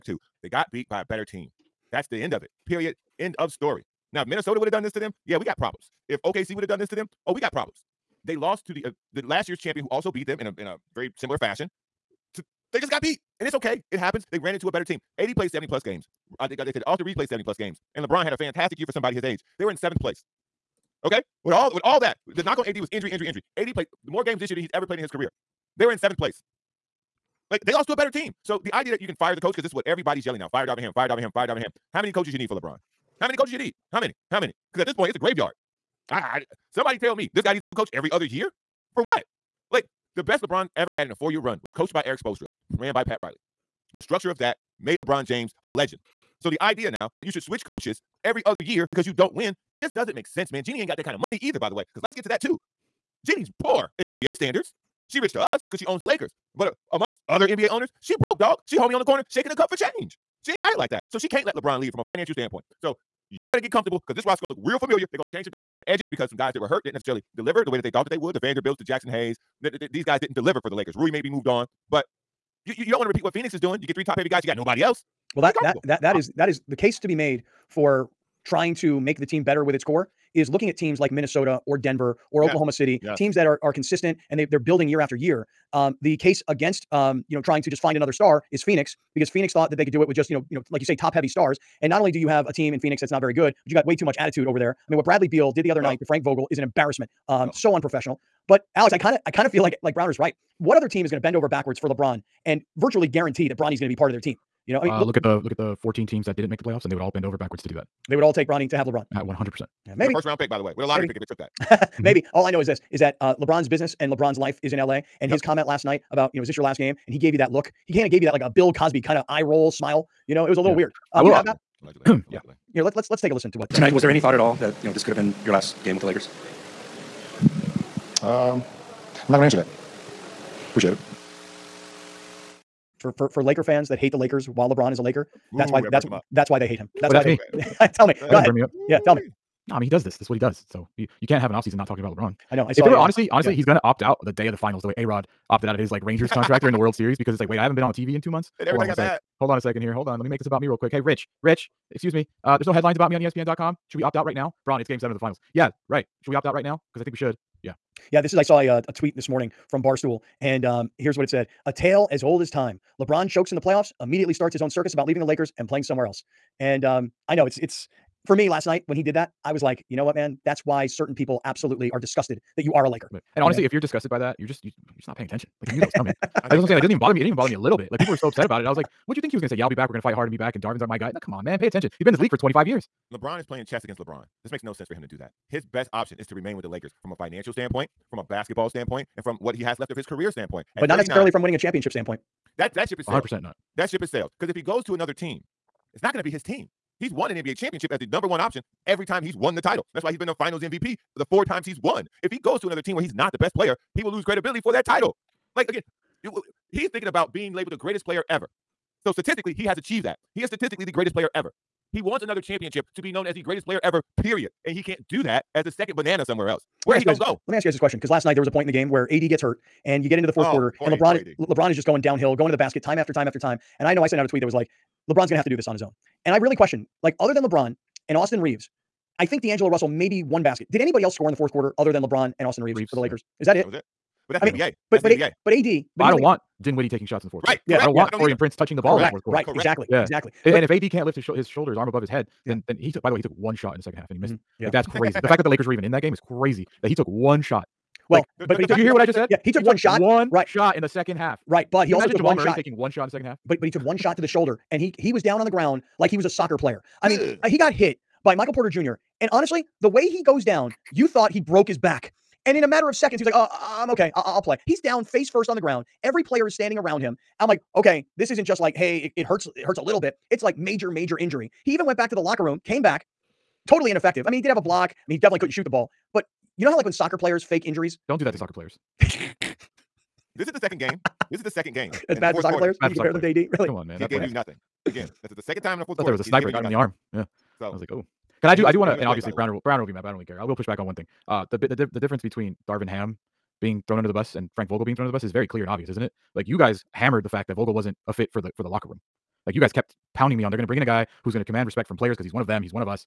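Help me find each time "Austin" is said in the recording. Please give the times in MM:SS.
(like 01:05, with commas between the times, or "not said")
00:16, 03:48, 03:52.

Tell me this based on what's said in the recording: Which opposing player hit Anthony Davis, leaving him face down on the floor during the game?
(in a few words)
Michael Porter Jr.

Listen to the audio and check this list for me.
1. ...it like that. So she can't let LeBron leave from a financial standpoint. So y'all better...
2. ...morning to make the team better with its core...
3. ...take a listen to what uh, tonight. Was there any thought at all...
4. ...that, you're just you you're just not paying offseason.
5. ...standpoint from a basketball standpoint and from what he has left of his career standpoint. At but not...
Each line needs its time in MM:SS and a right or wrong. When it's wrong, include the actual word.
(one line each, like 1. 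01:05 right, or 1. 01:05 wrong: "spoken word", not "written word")
1. 01:00 right
2. 01:18 wrong: "trying", not "morning"
3. 02:03 right
4. 02:54 wrong: "attention", not "offseason"
5. 03:07 right.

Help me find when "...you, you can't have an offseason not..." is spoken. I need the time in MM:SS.
02:20.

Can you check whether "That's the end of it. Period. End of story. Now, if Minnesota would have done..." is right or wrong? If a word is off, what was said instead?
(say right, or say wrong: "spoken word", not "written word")
right.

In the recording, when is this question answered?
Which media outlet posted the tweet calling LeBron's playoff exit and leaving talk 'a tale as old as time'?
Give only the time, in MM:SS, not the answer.
02:39.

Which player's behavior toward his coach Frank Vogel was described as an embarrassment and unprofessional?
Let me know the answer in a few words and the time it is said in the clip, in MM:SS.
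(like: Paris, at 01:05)
Bradley Beal, at 01:35.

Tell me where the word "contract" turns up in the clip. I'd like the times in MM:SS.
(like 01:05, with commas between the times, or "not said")
02:26.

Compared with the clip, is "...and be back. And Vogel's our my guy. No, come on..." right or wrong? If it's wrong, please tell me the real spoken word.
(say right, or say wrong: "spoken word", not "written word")
wrong: "Darvin", not "Vogel".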